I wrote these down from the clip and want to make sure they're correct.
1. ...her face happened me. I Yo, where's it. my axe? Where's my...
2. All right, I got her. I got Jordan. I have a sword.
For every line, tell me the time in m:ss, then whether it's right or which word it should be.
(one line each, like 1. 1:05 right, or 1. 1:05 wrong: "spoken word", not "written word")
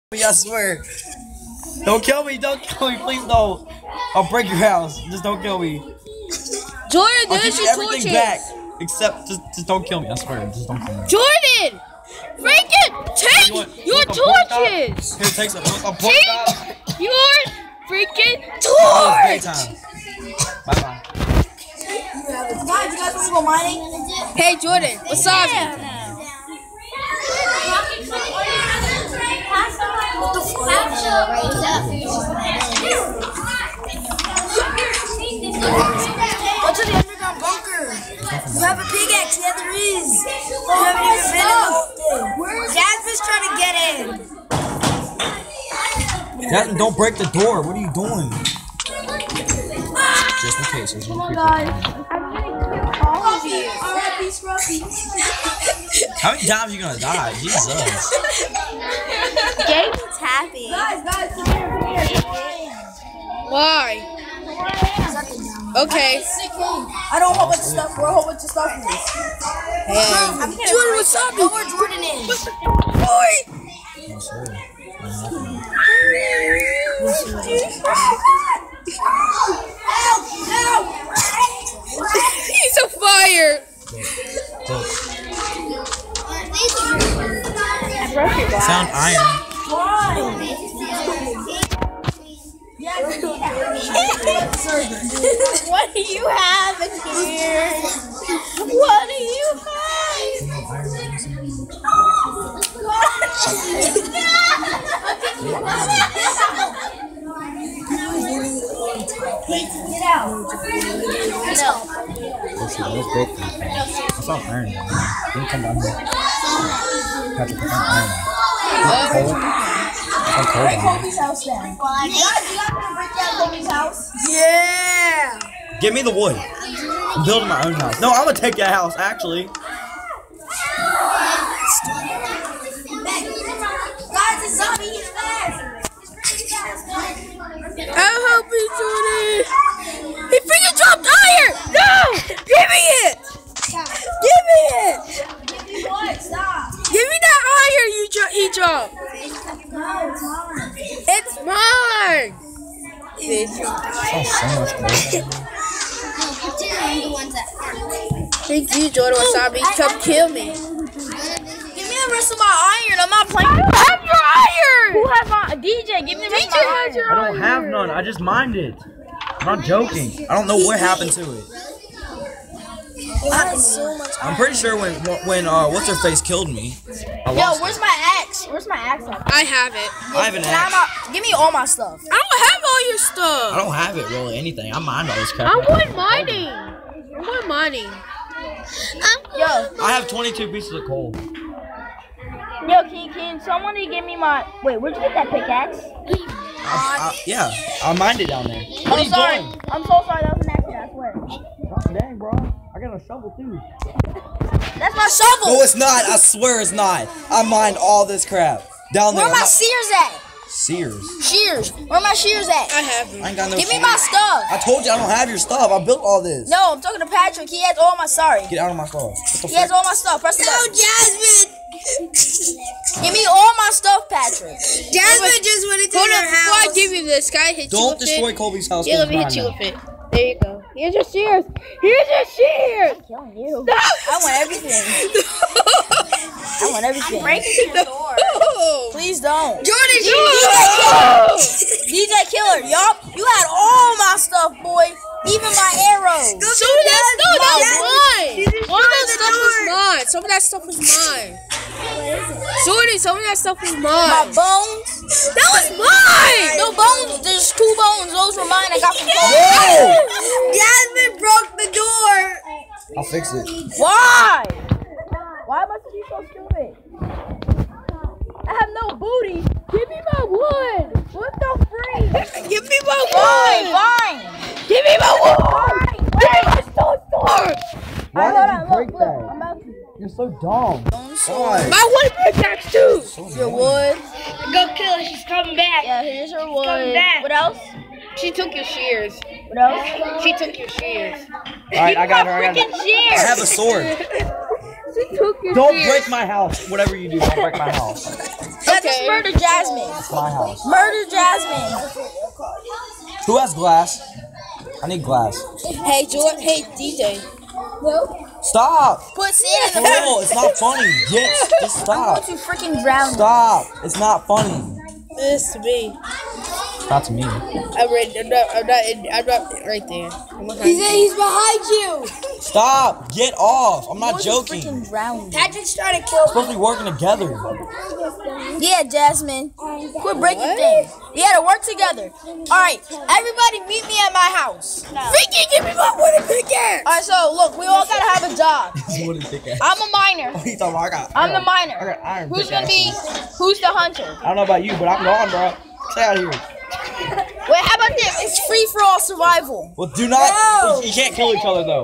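1. 2:55 wrong: "killed", not "happened"
2. 4:51 wrong: "Shears", not "Jordan".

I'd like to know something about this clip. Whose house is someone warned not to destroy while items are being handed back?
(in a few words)
Colby's.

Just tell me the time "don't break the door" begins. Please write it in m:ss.
0:46.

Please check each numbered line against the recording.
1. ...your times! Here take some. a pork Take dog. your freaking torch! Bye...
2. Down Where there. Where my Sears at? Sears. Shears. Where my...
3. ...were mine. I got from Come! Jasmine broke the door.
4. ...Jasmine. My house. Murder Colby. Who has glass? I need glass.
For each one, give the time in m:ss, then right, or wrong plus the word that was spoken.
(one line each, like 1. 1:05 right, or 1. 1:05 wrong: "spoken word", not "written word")
1. 0:13 wrong: "torches", not "times"
2. 3:28 right
3. 4:18 wrong: "Whoa", not "Come"
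4. 4:59 wrong: "Jasmine", not "Colby".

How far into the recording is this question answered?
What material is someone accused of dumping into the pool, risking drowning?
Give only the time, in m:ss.
5:09.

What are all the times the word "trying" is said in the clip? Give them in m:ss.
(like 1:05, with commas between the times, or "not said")
0:43, 5:25.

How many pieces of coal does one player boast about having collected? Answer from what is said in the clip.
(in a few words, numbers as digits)
22.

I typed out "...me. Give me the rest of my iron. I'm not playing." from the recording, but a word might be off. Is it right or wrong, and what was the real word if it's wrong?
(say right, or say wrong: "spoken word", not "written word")
right.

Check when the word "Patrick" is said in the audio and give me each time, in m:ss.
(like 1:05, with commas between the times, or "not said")
3:37, 3:44, 5:25.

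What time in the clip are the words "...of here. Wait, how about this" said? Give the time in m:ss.
5:46.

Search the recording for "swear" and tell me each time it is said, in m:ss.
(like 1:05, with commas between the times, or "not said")
0:00, 0:10, 3:21, 3:26.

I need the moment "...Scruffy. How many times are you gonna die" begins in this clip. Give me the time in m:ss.
0:54.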